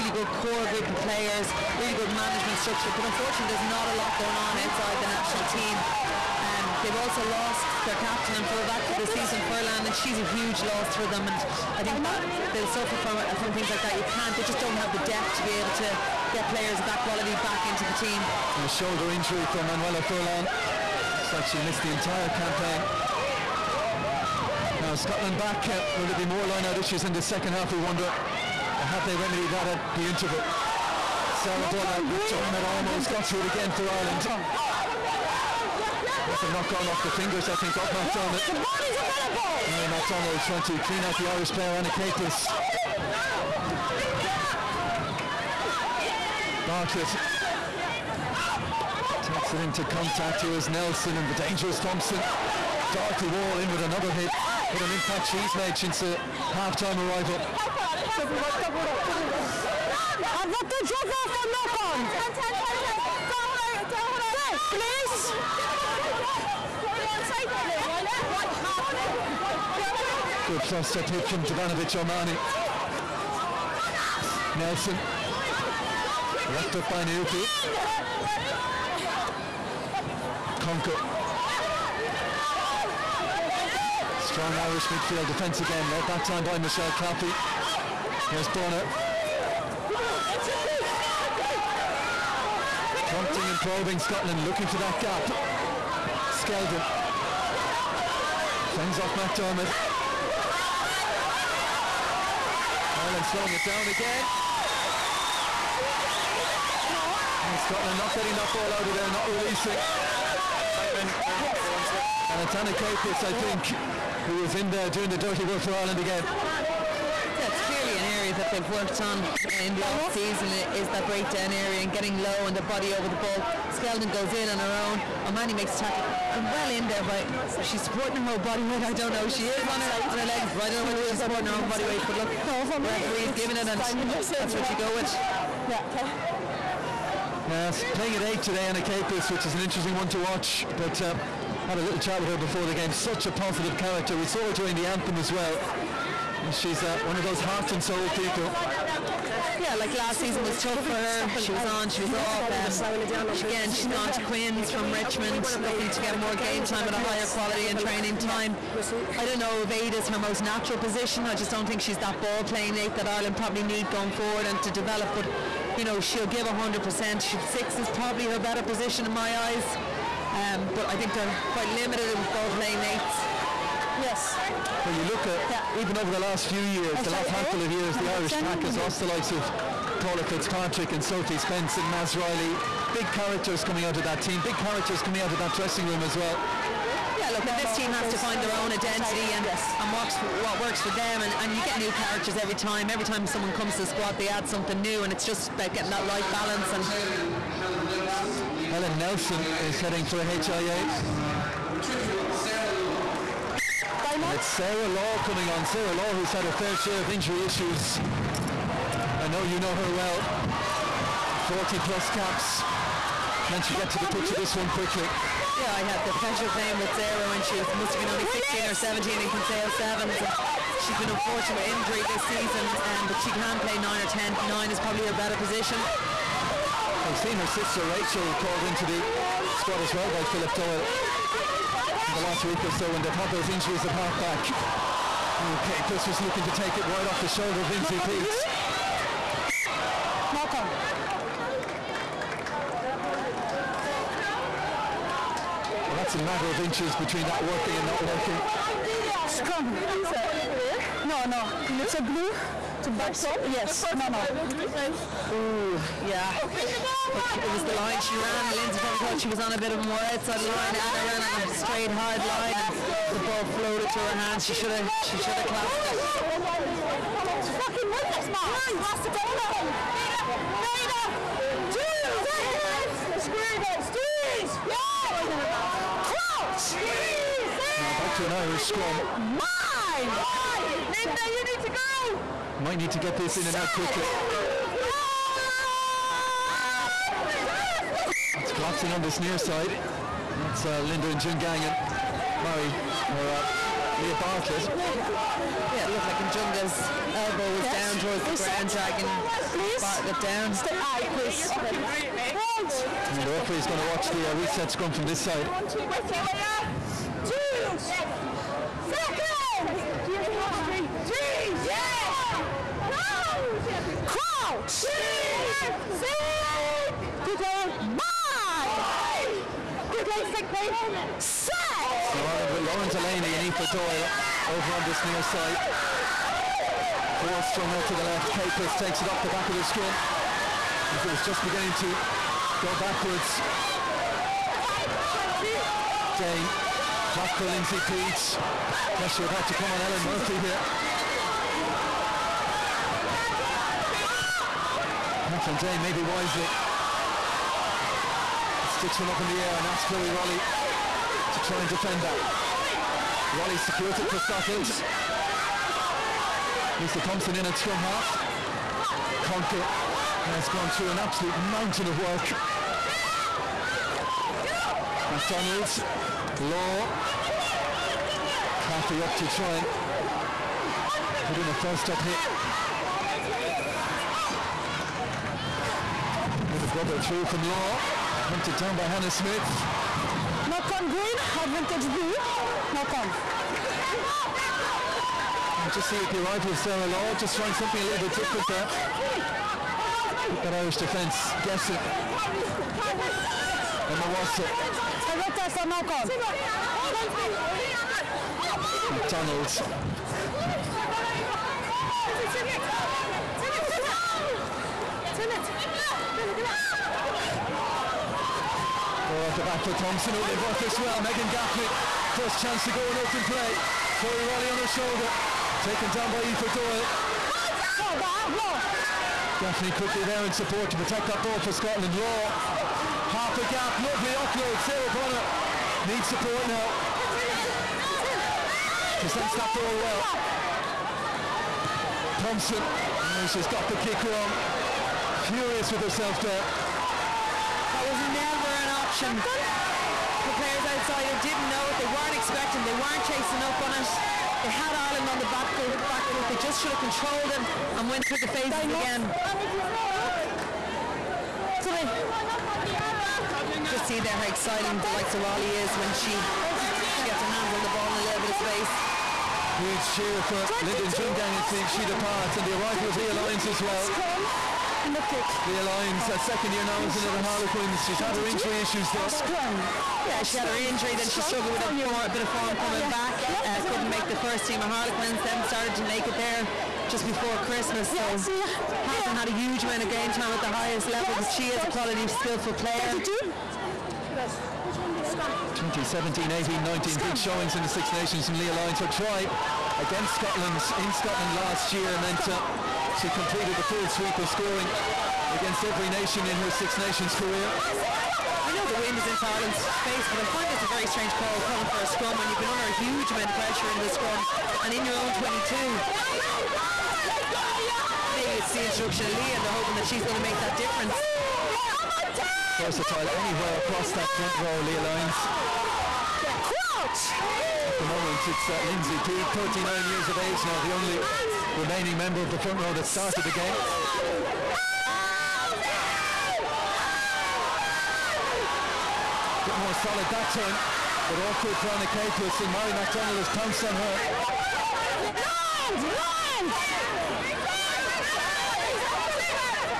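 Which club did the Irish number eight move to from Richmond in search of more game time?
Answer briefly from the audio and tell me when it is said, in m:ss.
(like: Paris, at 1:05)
Queens, at 2:34.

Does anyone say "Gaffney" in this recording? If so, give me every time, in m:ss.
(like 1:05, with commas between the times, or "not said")
6:51, 6:59.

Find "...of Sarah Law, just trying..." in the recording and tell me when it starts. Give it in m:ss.
6:26.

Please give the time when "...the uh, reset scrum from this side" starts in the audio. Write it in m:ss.
5:04.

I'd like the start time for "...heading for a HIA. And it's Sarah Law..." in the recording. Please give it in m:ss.
3:19.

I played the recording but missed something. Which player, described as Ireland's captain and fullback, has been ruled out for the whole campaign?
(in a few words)
Manuela Furlan.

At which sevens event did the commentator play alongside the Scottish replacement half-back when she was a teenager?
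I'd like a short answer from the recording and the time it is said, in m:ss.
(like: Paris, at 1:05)
Kinsale Sevens, at 3:39.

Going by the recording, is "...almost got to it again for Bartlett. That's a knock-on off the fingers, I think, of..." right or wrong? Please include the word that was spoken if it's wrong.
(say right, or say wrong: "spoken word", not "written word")
wrong: "Ireland", not "Bartlett".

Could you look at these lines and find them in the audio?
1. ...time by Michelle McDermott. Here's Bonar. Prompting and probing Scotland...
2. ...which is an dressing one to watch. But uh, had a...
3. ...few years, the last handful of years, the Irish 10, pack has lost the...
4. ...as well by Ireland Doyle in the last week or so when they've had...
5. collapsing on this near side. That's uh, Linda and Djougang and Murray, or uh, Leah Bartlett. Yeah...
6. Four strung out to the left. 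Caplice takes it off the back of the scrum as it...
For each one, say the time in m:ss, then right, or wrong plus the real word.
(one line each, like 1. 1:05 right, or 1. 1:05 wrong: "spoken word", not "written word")
1. 1:26 wrong: "Claffey", not "McDermott"
2. 2:19 wrong: "interesting", not "dressing"
3. 2:56 right
4. 3:49 wrong: "Philip", not "Ireland"
5. 4:48 right
6. 5:27 right.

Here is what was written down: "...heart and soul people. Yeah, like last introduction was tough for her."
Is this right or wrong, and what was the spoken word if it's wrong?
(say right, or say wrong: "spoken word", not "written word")
wrong: "season", not "introduction".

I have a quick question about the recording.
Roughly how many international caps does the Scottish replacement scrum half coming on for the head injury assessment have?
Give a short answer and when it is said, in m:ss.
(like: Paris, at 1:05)
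40-plus, at 3:31.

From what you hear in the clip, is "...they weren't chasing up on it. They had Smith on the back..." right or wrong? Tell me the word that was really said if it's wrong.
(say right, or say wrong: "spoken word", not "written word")
wrong: "Ireland", not "Smith".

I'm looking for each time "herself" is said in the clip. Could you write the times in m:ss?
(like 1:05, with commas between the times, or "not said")
7:15.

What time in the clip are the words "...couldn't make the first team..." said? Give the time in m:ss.
7:53.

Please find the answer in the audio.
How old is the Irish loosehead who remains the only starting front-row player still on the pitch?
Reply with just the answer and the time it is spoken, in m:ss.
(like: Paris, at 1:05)
39, at 8:39.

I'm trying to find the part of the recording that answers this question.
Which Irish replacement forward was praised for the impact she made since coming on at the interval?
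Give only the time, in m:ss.
0:52.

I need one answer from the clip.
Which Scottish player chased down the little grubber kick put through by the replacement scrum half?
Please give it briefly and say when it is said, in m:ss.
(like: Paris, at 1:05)
Hannah Smith, at 6:18.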